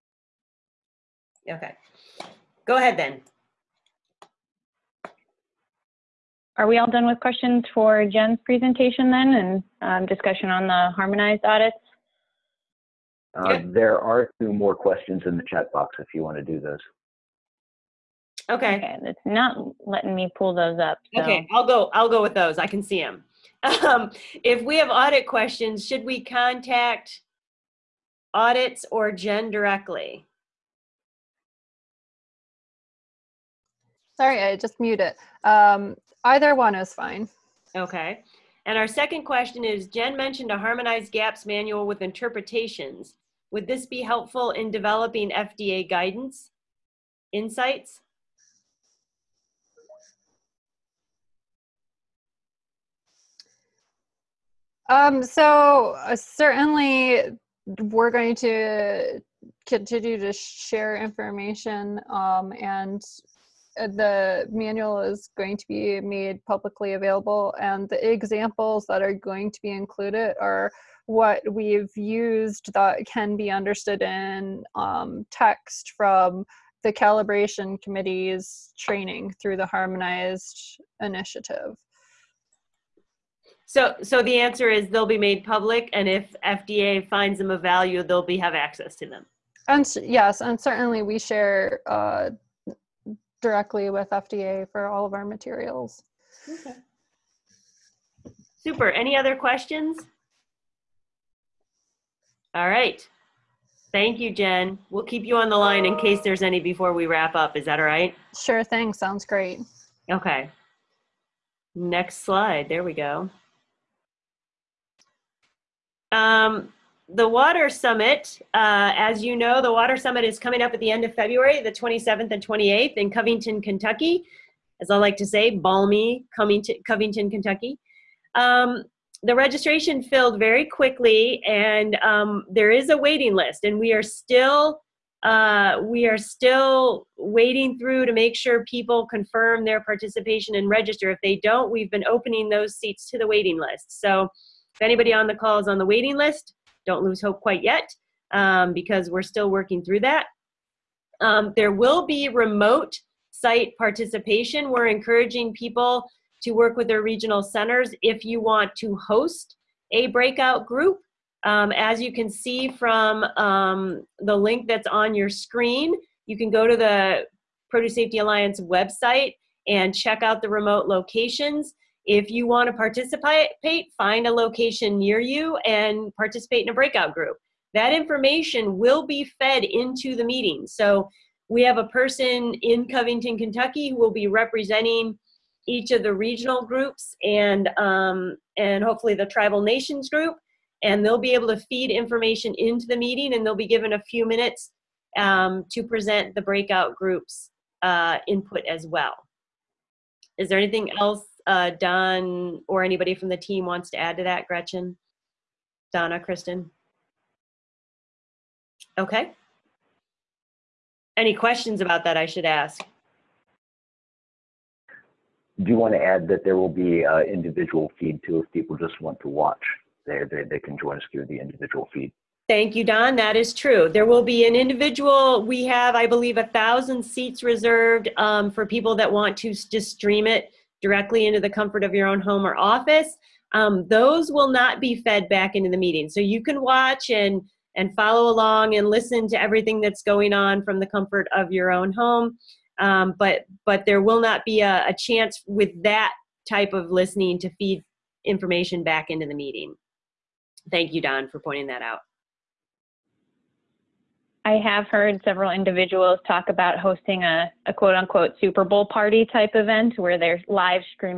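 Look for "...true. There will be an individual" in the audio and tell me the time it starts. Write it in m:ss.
3:43.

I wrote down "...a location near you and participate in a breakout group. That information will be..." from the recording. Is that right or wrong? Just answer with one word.
right.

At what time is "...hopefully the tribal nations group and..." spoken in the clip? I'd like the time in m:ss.
3:08.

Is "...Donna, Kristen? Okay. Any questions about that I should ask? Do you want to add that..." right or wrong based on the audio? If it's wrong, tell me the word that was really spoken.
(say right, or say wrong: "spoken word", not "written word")
right.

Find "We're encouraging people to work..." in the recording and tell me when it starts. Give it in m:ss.
2:34.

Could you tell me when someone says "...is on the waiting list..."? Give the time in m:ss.
2:25.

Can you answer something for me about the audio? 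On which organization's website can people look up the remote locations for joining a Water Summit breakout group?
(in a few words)
Produce Safety Alliance.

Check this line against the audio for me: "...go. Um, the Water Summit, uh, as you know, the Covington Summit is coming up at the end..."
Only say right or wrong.
wrong.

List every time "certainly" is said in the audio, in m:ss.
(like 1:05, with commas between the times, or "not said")
0:56, 1:30.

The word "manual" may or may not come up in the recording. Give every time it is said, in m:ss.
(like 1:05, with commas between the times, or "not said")
0:41, 1:04.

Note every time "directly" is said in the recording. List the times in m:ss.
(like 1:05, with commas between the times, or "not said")
0:29, 1:33, 3:50.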